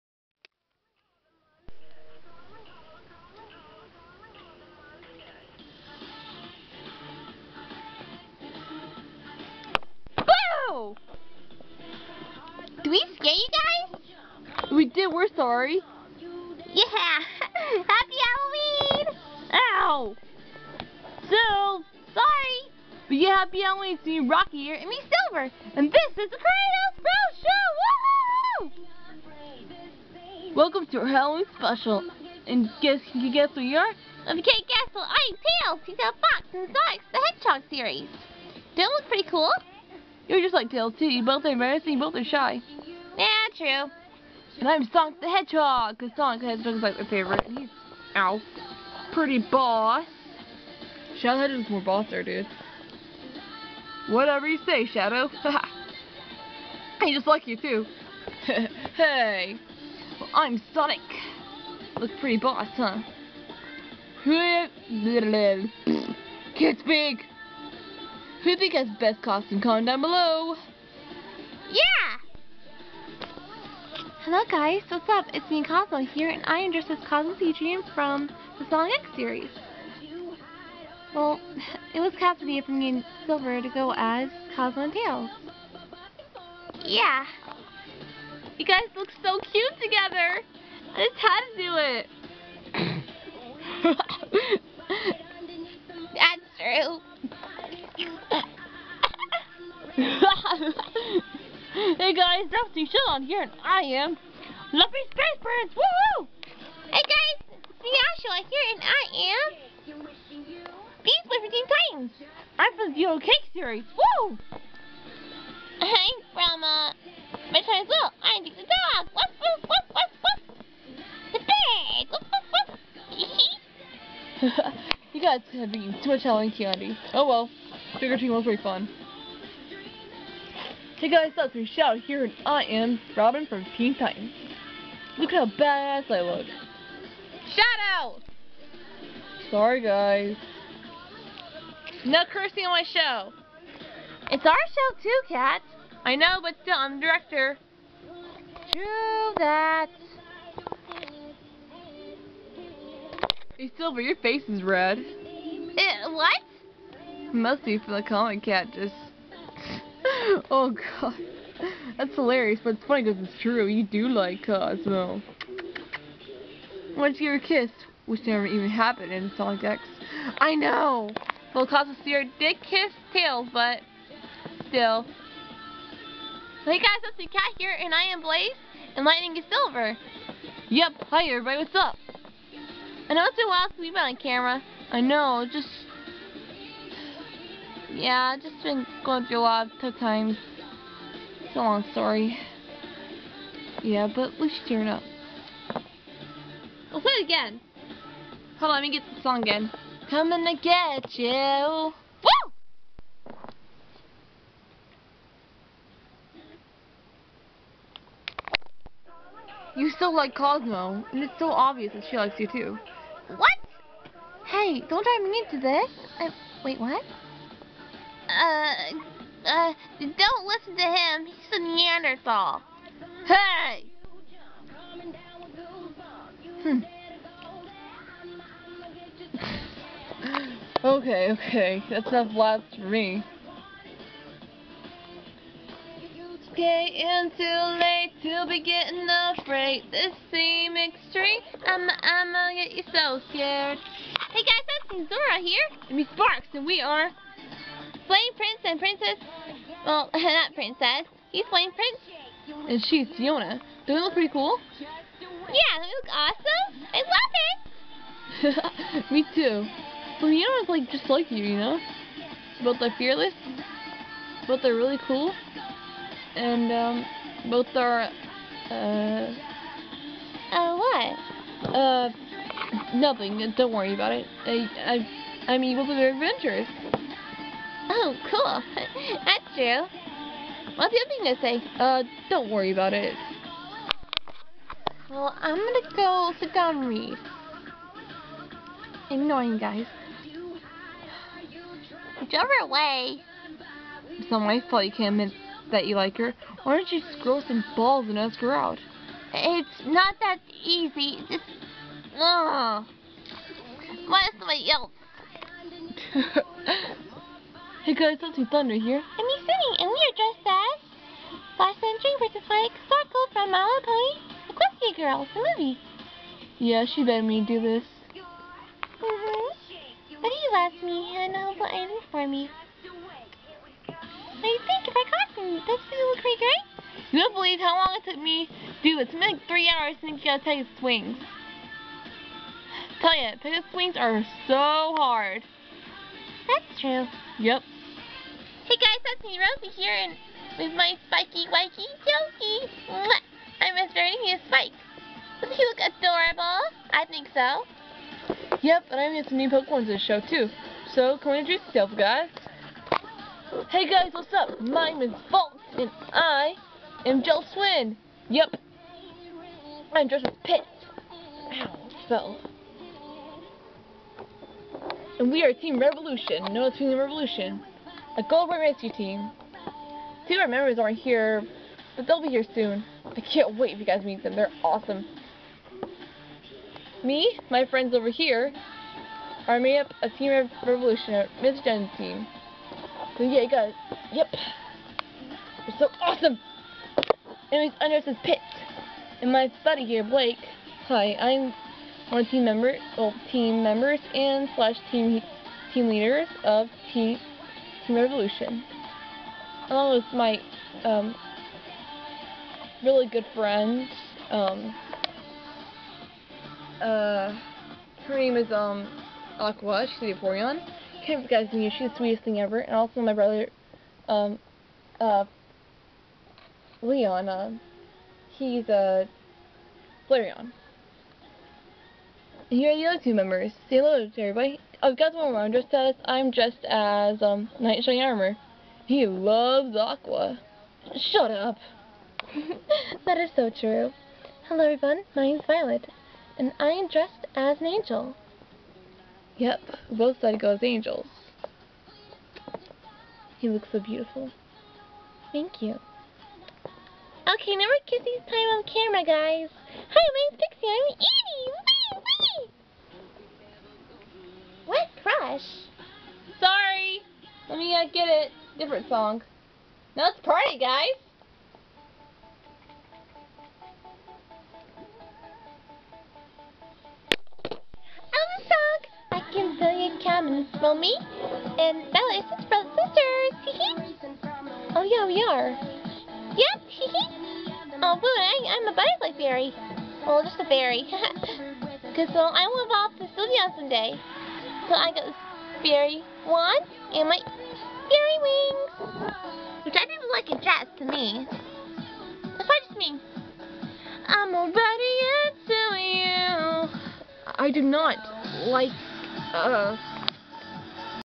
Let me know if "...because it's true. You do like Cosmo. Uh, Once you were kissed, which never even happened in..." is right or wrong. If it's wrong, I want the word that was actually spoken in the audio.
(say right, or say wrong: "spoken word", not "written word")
right.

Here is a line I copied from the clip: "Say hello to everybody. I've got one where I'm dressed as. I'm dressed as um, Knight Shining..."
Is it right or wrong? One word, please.
right.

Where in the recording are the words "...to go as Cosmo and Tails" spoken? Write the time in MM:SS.
01:23.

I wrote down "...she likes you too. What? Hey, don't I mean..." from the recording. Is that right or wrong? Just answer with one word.
right.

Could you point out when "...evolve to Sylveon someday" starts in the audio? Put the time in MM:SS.
08:02.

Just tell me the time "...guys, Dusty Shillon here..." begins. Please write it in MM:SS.
01:42.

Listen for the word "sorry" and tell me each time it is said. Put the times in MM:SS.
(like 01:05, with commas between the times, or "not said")
00:15, 00:22, 02:19, 07:36.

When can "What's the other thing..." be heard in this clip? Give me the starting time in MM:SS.
04:40.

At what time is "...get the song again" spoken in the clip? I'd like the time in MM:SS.
03:18.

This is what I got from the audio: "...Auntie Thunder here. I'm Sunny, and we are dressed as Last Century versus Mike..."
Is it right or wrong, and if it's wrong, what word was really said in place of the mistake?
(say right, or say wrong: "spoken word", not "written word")
right.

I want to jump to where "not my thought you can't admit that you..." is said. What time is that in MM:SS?
04:54.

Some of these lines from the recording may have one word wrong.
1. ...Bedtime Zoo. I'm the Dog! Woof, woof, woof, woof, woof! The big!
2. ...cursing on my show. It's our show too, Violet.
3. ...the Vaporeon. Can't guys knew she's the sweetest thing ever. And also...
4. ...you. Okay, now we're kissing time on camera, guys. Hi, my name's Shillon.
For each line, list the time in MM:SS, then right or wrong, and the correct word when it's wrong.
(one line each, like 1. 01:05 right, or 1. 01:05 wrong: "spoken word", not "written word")
1. 01:57 right
2. 02:22 wrong: "Cat", not "Violet"
3. 06:50 right
4. 07:25 wrong: "Pixie", not "Shillon".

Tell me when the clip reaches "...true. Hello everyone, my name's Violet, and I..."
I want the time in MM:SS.
07:13.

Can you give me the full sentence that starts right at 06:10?
Two of our members aren't here, but they'll be here soon.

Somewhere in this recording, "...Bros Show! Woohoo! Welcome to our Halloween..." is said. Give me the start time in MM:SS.
00:26.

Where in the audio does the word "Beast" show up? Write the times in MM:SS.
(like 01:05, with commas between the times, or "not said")
01:51.